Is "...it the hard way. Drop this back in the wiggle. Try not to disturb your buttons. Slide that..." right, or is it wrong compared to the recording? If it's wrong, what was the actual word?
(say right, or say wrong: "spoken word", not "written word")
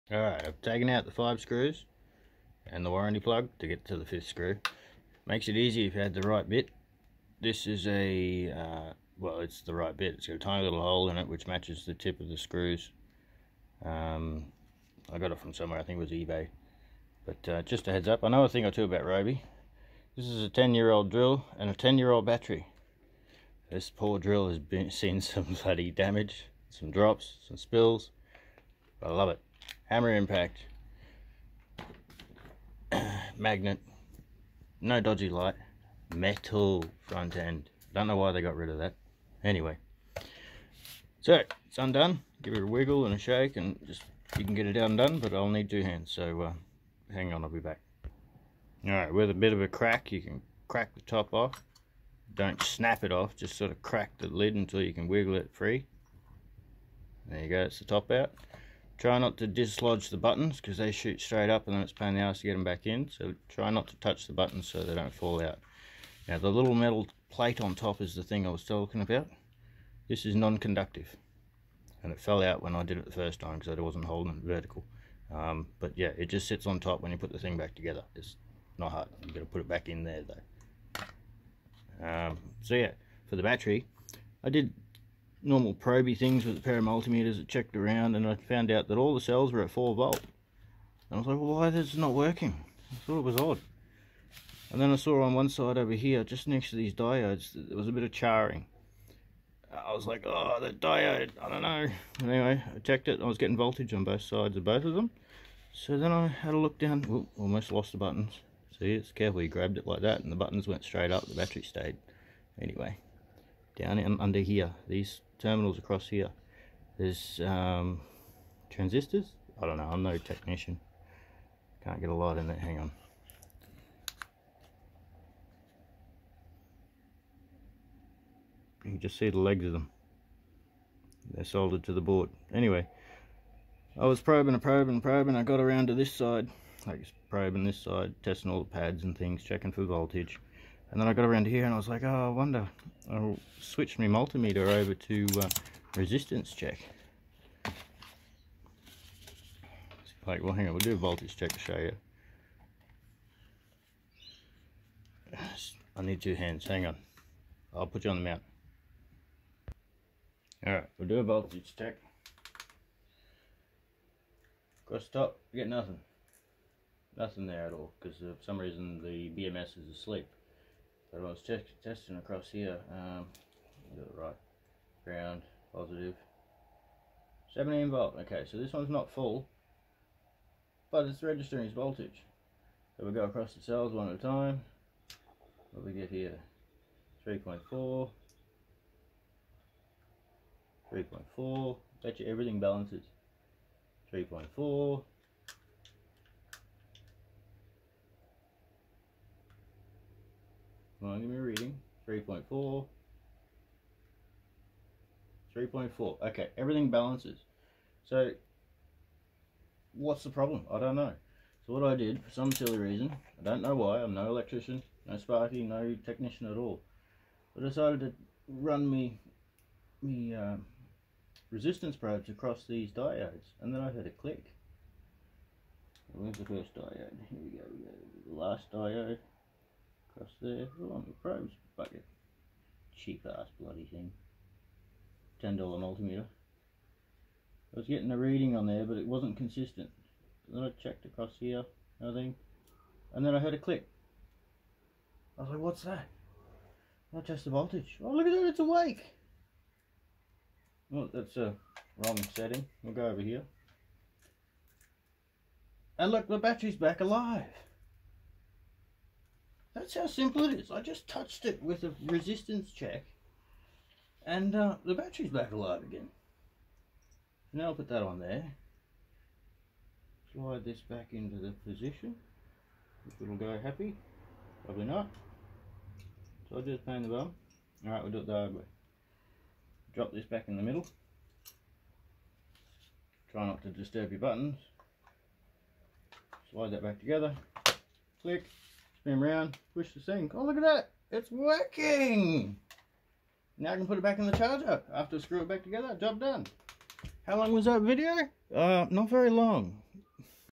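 wrong: "middle", not "wiggle".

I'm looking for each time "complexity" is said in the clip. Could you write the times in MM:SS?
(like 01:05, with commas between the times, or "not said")
not said.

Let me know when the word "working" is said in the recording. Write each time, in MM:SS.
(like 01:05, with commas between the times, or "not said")
01:32, 04:51.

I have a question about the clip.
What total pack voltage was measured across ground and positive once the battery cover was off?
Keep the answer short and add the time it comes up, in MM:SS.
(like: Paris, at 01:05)
17 volt, at 02:57.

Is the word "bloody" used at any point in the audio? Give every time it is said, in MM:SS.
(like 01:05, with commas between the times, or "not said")
00:25, 03:53.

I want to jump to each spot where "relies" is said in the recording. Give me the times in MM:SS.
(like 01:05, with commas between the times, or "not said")
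not said.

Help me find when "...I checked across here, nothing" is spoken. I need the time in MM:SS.
04:00.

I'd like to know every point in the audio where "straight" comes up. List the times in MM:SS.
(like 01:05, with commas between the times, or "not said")
01:01, 01:50.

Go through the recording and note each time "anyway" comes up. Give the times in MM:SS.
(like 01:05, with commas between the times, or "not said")
00:39, 01:42, 01:52, 02:12.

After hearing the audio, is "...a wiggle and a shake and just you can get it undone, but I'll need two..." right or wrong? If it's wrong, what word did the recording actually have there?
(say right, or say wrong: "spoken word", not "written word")
right.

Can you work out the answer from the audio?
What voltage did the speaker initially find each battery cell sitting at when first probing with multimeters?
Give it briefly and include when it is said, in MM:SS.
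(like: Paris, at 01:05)
4 volt, at 01:29.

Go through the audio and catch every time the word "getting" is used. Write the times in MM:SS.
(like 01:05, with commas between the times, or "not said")
01:43, 03:57.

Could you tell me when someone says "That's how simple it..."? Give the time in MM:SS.
04:19.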